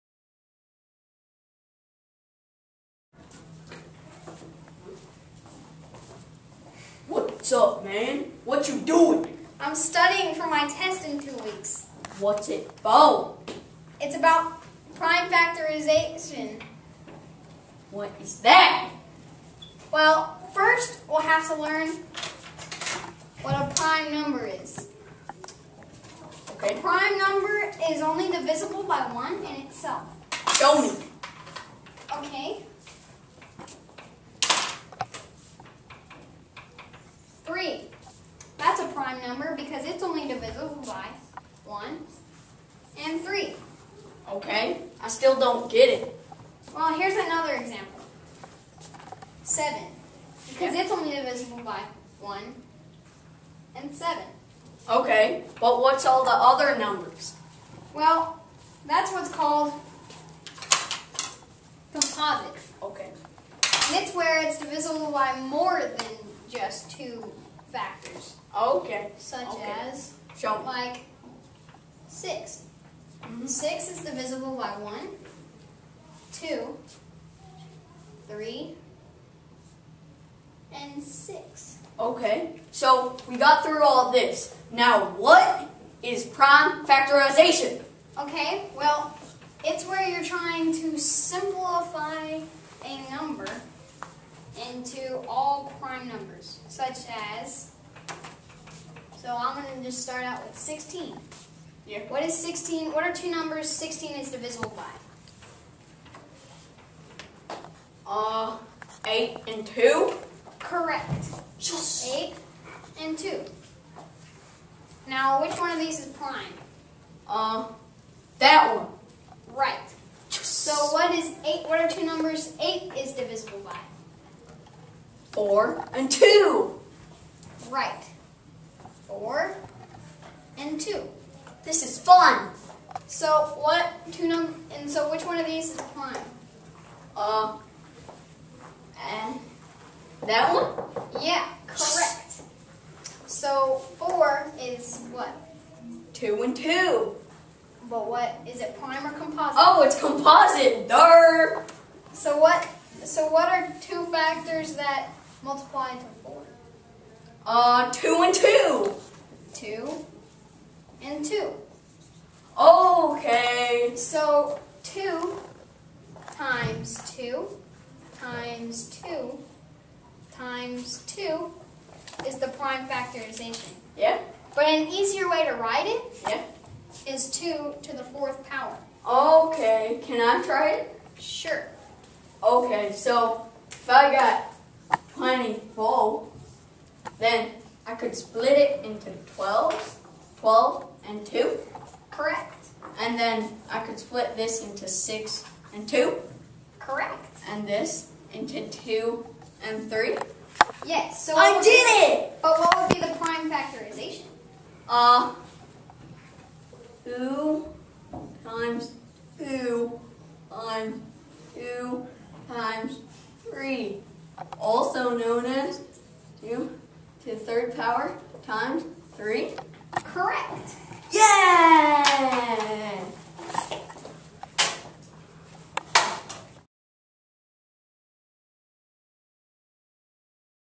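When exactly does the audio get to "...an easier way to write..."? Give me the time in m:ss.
2:54.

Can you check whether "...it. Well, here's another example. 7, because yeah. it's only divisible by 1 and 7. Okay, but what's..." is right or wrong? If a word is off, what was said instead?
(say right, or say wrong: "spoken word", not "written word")
right.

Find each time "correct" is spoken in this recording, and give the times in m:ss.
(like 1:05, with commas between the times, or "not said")
1:50, 2:21, 3:12, 3:16, 3:40.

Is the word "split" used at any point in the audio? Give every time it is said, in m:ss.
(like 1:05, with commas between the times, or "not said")
3:08, 3:13.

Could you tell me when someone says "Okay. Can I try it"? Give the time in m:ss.
2:59.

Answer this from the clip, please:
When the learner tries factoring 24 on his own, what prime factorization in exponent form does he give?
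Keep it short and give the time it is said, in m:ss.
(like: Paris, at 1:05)
2 to the third power times 3, at 3:36.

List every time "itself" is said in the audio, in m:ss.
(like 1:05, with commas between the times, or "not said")
0:29.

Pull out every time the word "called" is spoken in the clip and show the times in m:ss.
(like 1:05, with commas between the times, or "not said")
0:59.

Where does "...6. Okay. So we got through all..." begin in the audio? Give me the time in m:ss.
1:21.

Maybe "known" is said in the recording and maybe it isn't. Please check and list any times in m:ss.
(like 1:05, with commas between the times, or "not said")
3:35.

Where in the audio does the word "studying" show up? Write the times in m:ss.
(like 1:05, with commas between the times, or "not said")
0:09.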